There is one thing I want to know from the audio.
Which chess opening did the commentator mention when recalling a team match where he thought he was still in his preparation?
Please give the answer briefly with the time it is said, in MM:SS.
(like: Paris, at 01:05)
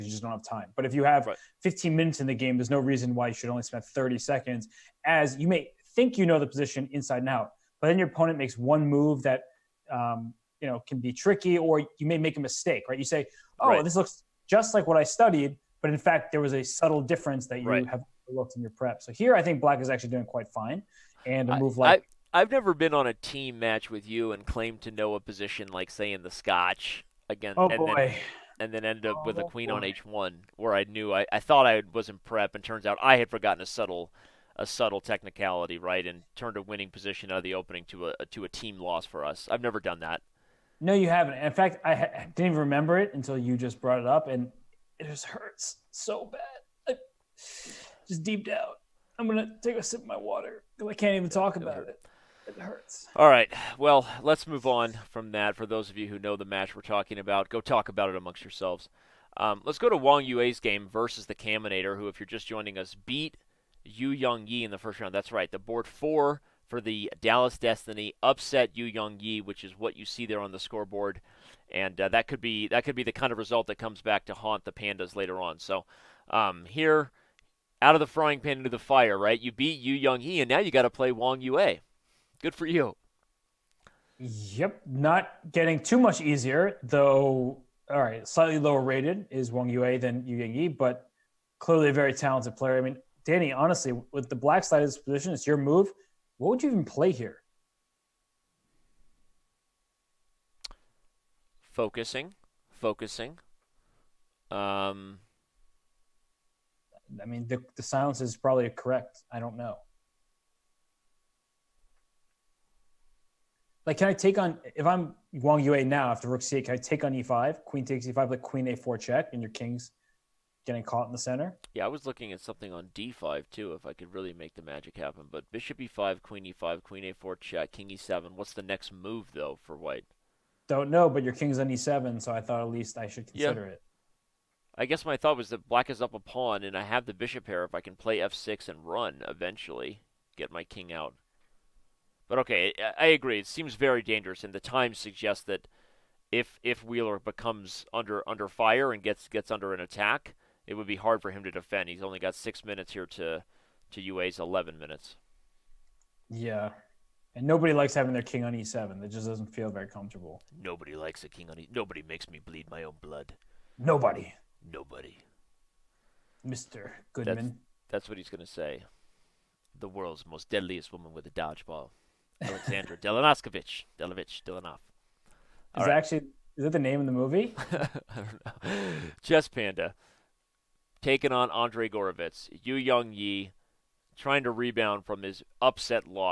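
Scotch, at 00:26.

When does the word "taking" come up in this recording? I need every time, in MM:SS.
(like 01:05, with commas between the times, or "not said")
03:01.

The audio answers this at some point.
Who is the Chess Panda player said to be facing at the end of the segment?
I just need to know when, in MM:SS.
03:01.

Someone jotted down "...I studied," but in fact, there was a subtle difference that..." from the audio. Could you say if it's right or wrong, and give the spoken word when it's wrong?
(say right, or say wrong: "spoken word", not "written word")
right.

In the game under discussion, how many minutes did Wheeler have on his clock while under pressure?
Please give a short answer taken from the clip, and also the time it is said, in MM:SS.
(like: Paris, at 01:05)
6, at 02:32.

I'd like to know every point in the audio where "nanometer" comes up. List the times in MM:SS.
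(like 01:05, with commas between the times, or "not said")
not said.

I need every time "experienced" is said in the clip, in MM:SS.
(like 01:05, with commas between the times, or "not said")
not said.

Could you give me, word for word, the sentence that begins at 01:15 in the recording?
So um, here, out of the frying pan into the fire, right?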